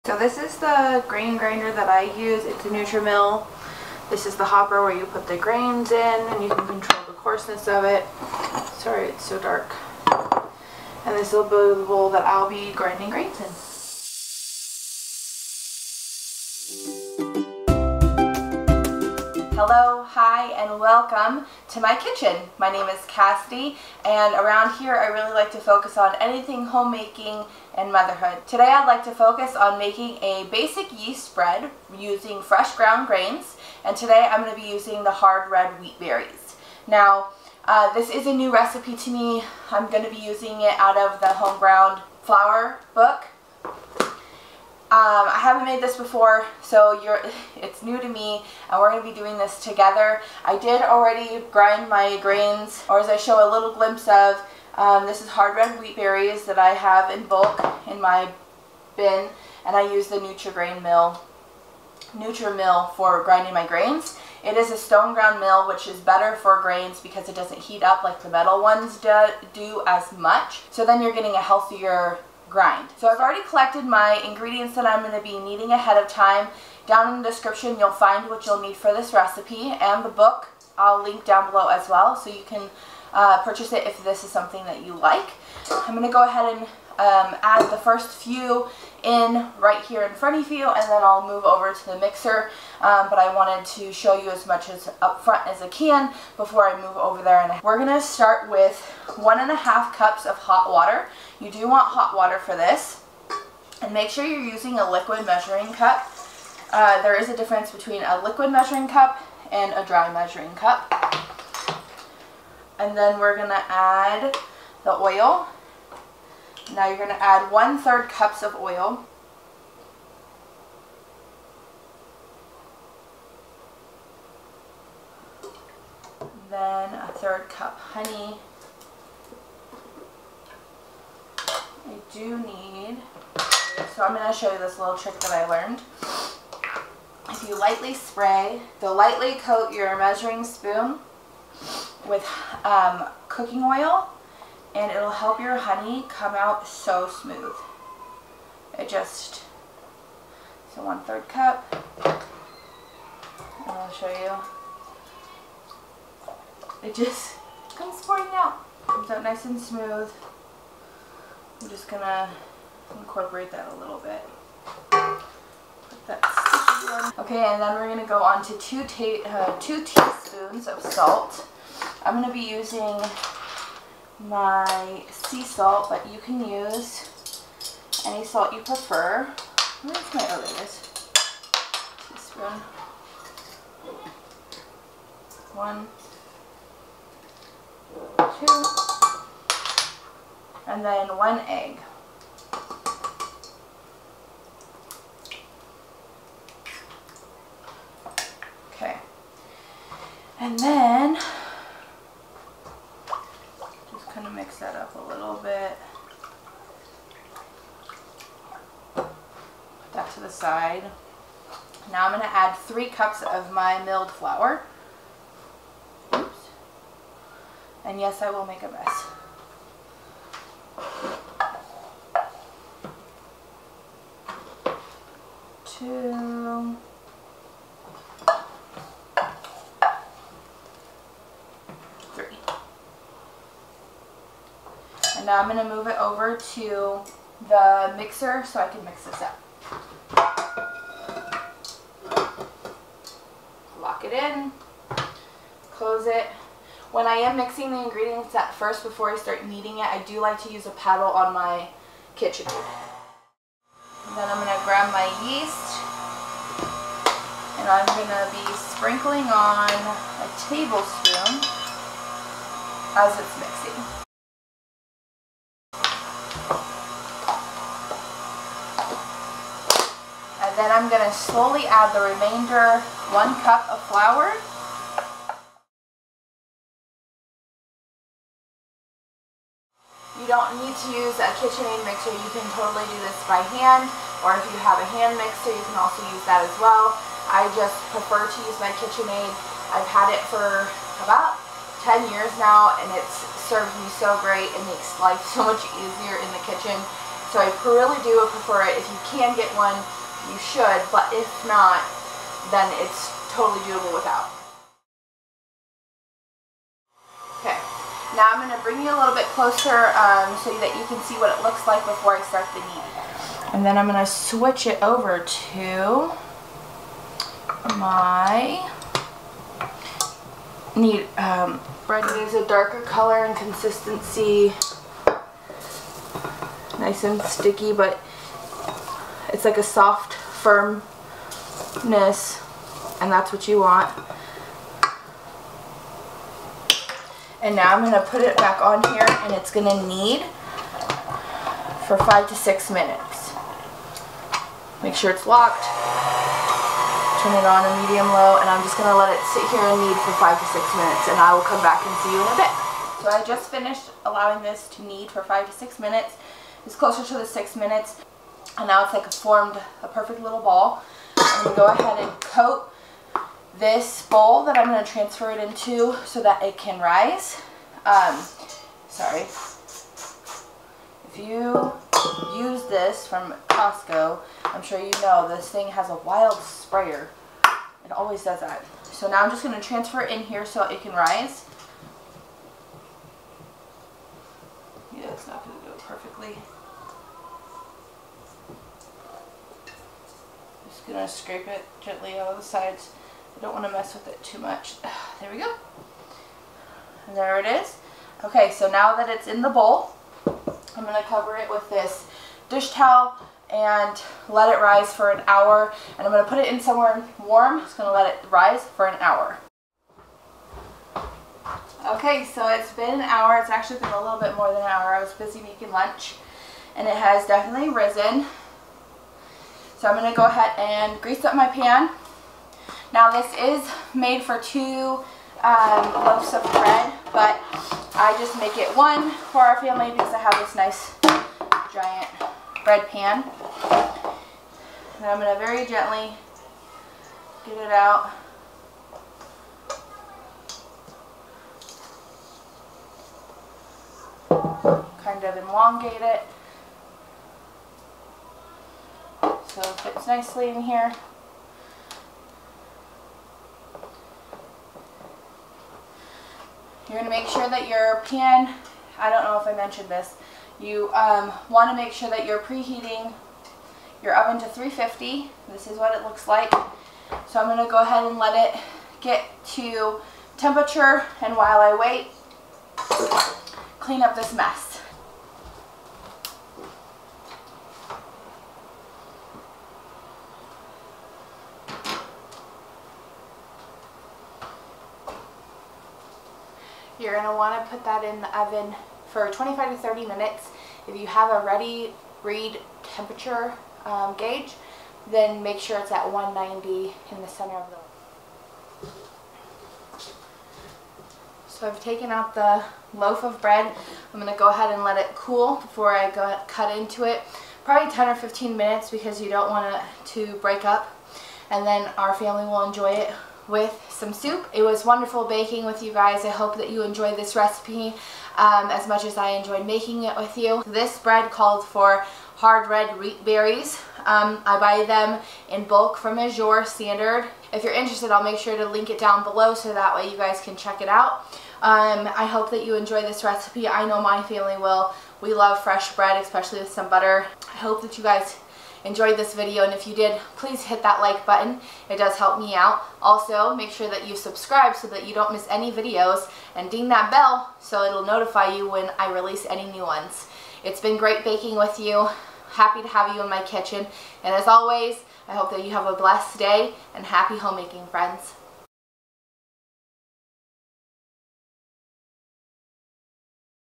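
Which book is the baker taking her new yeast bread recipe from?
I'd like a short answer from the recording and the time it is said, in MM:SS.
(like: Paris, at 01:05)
Home Ground Flour, at 00:41.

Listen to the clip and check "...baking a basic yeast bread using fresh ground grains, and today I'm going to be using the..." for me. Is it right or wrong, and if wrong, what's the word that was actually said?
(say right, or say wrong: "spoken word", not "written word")
wrong: "making", not "baking".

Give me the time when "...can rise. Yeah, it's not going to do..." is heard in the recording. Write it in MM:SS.
06:20.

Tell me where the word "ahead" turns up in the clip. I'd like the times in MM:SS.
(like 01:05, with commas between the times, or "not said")
01:15, 01:26, 06:01, 07:00, 07:47, 08:24.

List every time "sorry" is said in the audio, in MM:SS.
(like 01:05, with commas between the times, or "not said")
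00:08, 06:08.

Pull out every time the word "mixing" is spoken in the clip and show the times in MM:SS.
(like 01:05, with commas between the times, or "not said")
04:07, 04:23.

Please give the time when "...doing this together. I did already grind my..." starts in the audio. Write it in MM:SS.
00:49.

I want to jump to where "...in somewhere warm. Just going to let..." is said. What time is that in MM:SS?
06:46.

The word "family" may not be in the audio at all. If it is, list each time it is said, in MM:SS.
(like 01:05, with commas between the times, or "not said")
07:09, 08:32, 08:54.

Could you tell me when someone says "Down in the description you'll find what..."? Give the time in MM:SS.
01:16.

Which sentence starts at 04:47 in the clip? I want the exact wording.
I just prefer to use my KitchenAid.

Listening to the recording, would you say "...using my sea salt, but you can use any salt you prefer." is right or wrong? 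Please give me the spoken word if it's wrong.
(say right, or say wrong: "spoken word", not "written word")
right.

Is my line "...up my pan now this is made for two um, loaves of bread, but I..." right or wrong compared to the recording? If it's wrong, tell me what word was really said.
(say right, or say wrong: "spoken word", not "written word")
right.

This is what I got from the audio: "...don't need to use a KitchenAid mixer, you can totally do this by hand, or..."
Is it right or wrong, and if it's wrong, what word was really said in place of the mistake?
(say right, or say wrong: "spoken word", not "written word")
right.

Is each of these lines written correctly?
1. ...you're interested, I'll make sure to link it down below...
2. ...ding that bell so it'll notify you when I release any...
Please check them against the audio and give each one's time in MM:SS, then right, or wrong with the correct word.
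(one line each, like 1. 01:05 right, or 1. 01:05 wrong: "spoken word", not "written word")
1. 08:47 right
2. 09:06 right.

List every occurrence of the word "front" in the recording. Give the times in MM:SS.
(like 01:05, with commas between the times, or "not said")
01:30, 01:35.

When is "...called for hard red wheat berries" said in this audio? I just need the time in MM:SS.
08:41.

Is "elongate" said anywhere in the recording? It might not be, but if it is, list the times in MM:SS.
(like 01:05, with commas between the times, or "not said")
07:25.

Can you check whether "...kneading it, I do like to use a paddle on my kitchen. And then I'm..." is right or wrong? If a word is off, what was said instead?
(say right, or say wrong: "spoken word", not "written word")
right.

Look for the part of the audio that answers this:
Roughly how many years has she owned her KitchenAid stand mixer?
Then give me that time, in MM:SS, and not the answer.
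04:51.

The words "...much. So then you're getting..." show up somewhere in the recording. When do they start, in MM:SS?
01:10.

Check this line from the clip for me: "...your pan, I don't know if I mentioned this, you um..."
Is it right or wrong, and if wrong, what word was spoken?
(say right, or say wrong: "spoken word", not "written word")
right.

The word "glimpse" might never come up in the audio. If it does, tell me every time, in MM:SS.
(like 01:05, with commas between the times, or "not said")
00:53.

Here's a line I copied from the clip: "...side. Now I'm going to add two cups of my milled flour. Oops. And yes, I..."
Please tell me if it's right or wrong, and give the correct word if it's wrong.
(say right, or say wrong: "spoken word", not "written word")
wrong: "three", not "two".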